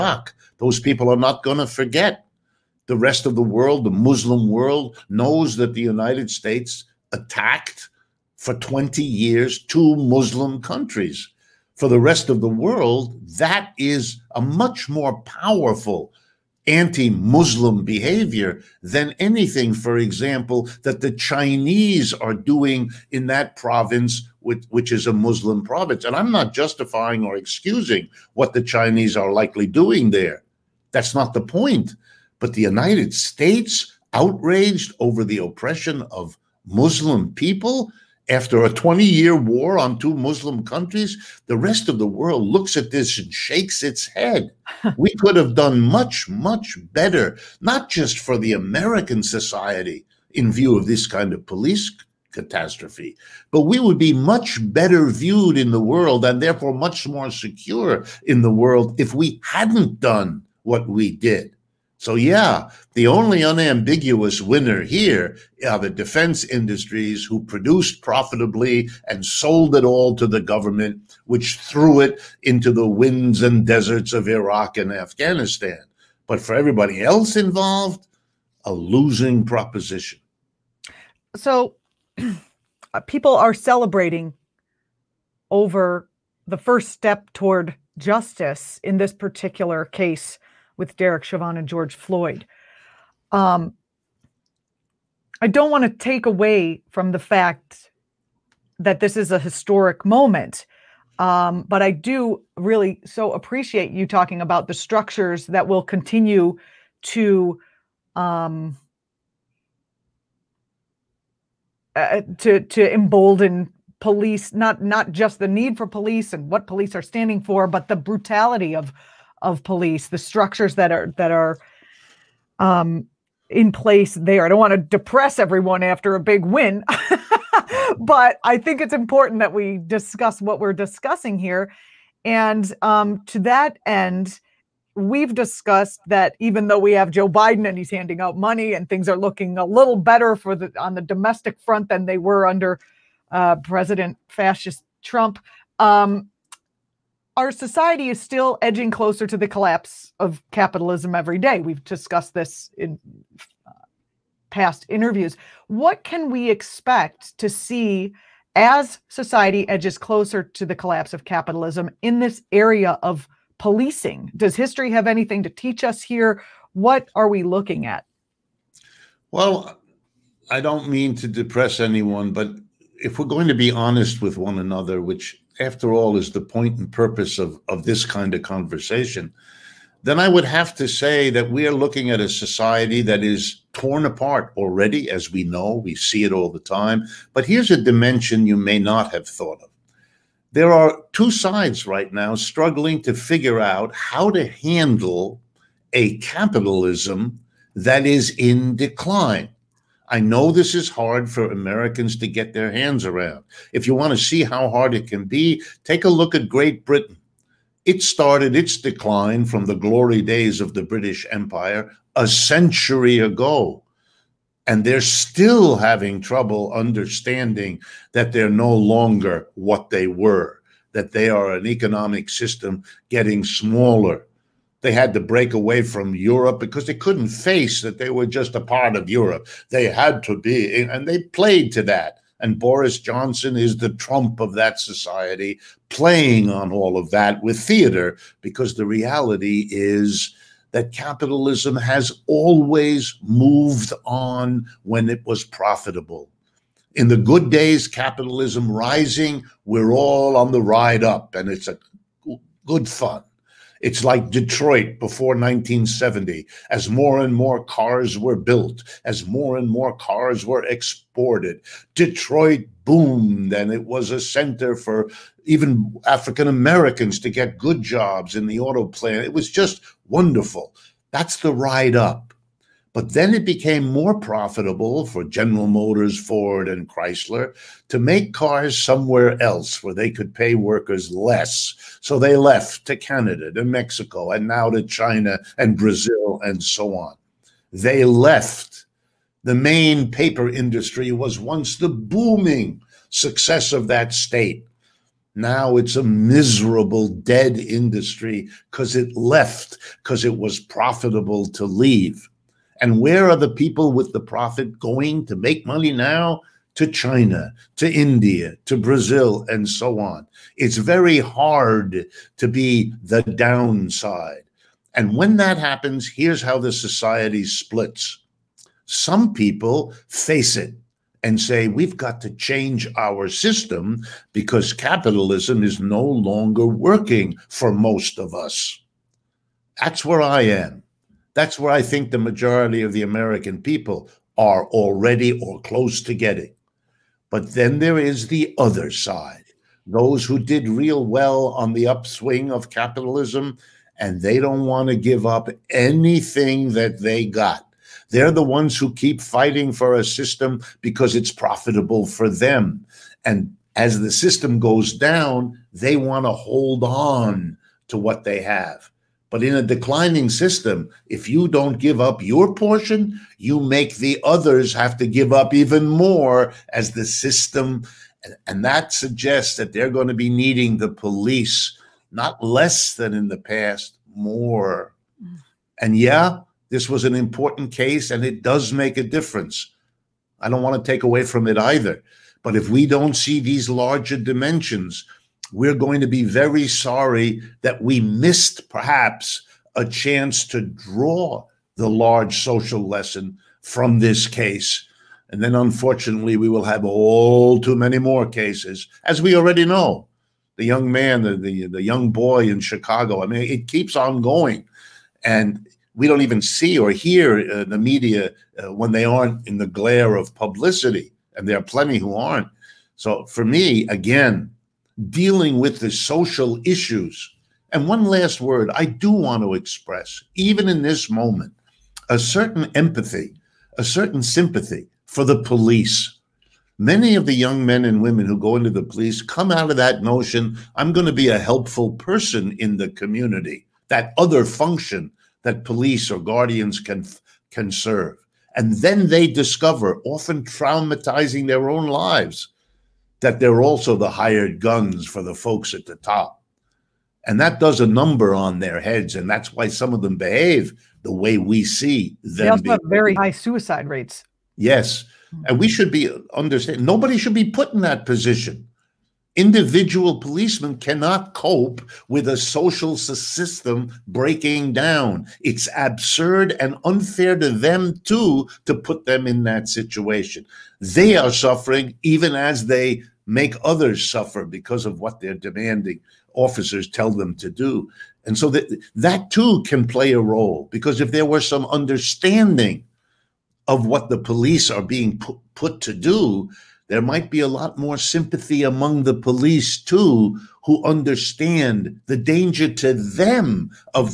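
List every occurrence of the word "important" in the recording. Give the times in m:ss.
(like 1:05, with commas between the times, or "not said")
2:08, 6:17.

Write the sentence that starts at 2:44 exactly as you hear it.
Does history have anything to teach us here?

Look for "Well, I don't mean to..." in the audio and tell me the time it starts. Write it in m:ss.
2:49.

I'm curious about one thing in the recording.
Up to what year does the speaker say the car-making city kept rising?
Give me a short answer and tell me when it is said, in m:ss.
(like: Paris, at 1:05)
1970, at 4:15.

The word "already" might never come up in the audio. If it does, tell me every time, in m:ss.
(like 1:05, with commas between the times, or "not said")
3:04, 5:34, 6:39.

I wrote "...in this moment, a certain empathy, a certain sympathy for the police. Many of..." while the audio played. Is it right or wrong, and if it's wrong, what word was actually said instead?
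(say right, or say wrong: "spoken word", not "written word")
right.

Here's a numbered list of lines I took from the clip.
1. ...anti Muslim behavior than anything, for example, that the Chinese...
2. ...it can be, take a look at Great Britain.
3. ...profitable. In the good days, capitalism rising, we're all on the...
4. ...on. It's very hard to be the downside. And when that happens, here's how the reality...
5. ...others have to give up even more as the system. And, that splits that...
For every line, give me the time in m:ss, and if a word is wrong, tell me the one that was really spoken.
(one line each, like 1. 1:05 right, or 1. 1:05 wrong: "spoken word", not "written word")
1. 0:16 right
2. 3:24 right
3. 4:05 right
4. 5:09 wrong: "society", not "reality"
5. 6:04 wrong: "suggests", not "splits".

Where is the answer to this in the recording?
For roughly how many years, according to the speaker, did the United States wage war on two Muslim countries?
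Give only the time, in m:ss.
0:08.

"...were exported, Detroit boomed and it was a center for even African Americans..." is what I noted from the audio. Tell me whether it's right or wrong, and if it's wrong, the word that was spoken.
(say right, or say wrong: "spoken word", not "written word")
right.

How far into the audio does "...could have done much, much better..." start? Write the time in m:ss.
0:45.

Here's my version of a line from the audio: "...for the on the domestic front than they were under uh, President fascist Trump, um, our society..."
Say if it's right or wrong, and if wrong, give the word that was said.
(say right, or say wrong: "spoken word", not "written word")
right.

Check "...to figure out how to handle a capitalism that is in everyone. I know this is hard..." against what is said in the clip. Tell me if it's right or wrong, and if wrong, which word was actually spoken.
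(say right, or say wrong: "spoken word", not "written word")
wrong: "decline", not "everyone".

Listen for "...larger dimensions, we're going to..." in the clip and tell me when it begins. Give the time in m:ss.
6:23.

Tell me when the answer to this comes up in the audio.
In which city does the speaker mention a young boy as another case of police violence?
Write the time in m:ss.
6:42.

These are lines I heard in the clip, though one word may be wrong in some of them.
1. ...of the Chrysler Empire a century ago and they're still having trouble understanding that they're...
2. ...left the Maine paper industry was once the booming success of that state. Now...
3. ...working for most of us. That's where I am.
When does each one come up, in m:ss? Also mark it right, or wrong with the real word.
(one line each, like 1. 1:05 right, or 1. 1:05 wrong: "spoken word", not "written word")
1. 3:30 wrong: "British", not "Chrysler"
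2. 4:48 right
3. 5:26 right.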